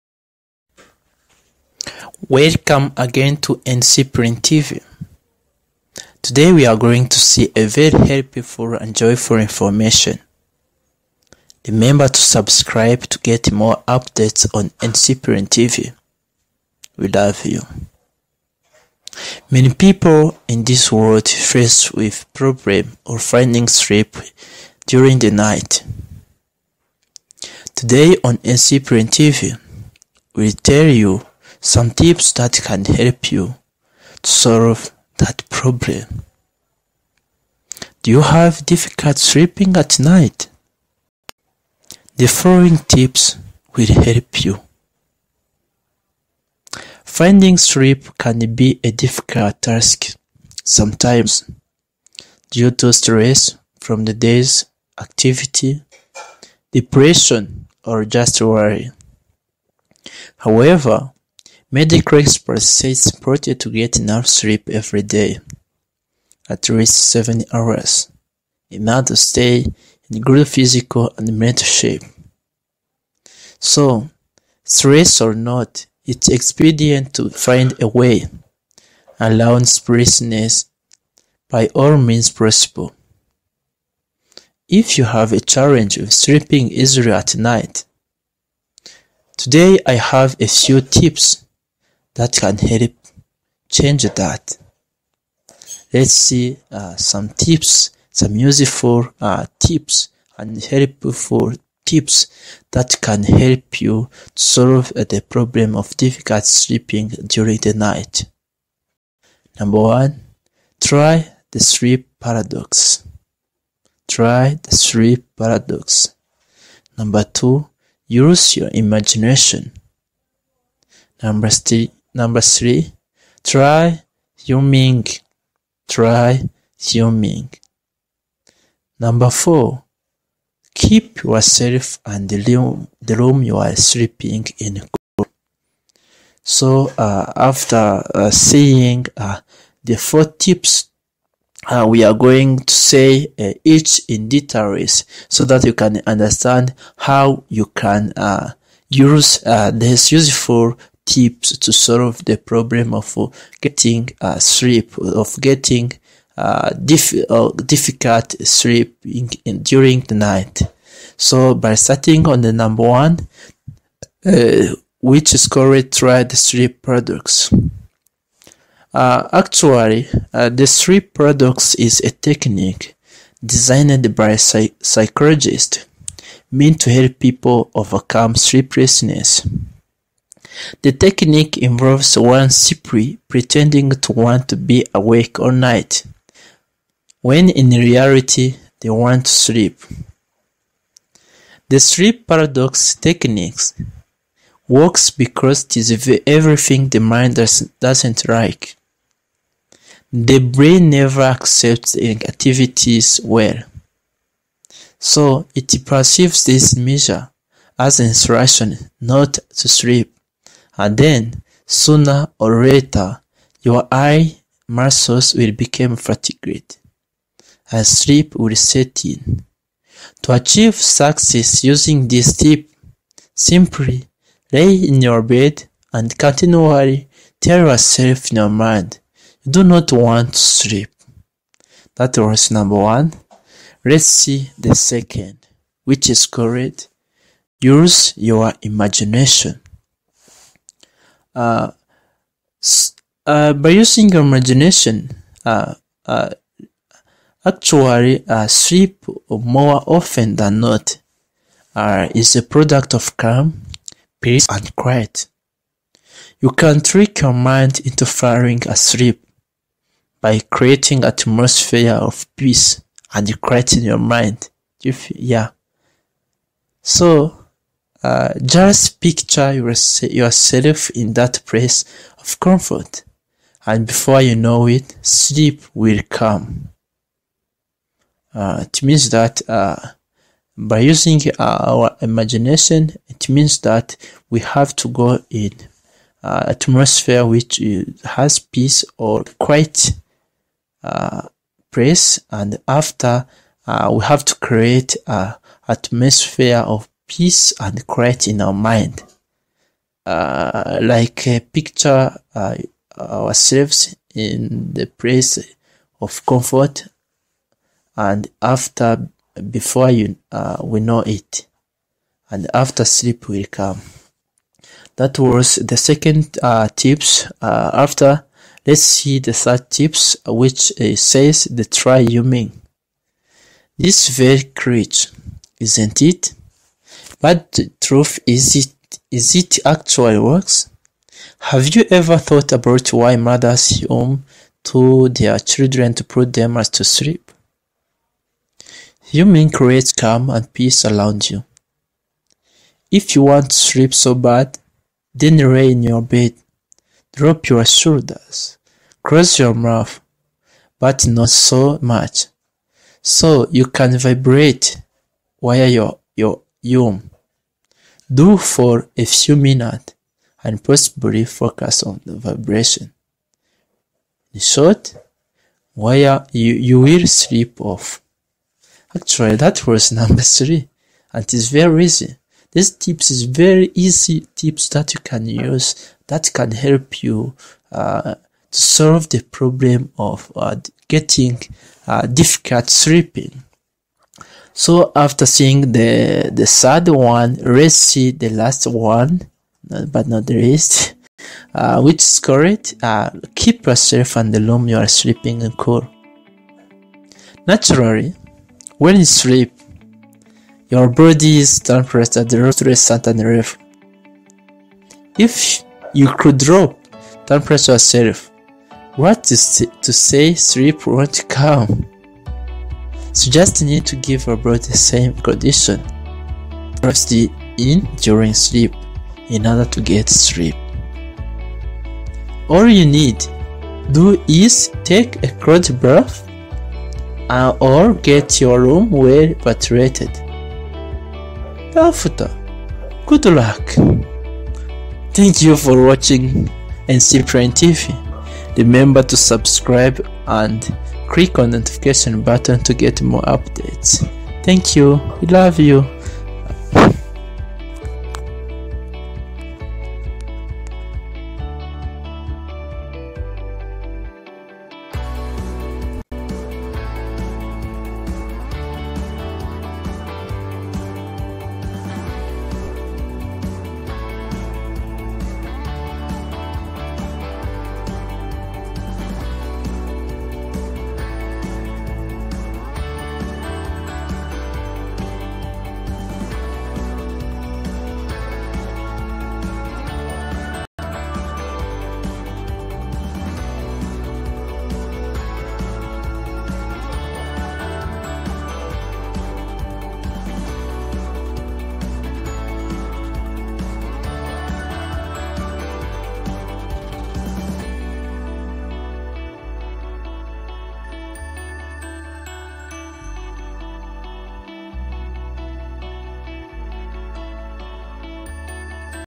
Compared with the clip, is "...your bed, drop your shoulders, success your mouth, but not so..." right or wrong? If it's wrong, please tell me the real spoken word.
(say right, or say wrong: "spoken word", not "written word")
wrong: "cross", not "success".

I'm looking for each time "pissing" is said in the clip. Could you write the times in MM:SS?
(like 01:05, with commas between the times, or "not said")
not said.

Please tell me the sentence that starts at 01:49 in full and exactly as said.
Number one, try the sleep paradox.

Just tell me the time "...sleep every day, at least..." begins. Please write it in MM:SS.
01:04.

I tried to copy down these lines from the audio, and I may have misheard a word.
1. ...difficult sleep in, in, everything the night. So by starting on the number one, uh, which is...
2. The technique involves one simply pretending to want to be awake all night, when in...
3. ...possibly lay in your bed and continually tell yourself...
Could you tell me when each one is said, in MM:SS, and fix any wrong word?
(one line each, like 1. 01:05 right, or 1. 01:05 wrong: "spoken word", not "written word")
1. 02:37 wrong: "during", not "everything"
2. 03:00 right
3. 03:43 wrong: "simply", not "possibly".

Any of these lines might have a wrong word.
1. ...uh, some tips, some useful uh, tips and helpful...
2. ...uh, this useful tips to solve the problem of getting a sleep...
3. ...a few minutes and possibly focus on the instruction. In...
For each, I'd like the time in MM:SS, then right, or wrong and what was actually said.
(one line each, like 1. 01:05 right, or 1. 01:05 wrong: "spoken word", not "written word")
1. 01:36 right
2. 02:29 right
3. 05:58 wrong: "vibration", not "instruction".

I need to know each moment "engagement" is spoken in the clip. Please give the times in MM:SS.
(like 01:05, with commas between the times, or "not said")
not said.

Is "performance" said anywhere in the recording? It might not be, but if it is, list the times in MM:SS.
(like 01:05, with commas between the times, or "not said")
not said.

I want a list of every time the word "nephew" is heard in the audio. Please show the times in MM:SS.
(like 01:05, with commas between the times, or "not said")
not said.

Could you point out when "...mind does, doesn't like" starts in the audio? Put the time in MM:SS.
03:16.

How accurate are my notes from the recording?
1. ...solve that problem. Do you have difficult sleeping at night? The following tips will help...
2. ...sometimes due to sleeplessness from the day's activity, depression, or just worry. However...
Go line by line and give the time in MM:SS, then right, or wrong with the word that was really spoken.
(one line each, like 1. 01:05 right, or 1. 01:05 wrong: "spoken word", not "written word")
1. 00:34 right
2. 00:50 wrong: "stress", not "sleeplessness".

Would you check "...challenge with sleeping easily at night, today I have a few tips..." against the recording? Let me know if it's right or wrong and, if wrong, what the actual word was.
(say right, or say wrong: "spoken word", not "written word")
right.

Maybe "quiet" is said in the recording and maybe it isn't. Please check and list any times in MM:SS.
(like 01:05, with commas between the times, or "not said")
04:14, 04:23, 04:49.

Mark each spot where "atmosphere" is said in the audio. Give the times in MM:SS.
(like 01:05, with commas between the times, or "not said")
04:21, 04:46, 04:55.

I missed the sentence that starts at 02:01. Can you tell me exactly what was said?
Number three, Number three, try Ming.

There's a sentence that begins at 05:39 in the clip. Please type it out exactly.
You mean calm and peace around you.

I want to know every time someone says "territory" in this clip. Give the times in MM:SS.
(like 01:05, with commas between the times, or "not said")
not said.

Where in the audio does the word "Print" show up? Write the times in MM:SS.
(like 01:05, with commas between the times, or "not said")
00:04, 00:15, 00:28.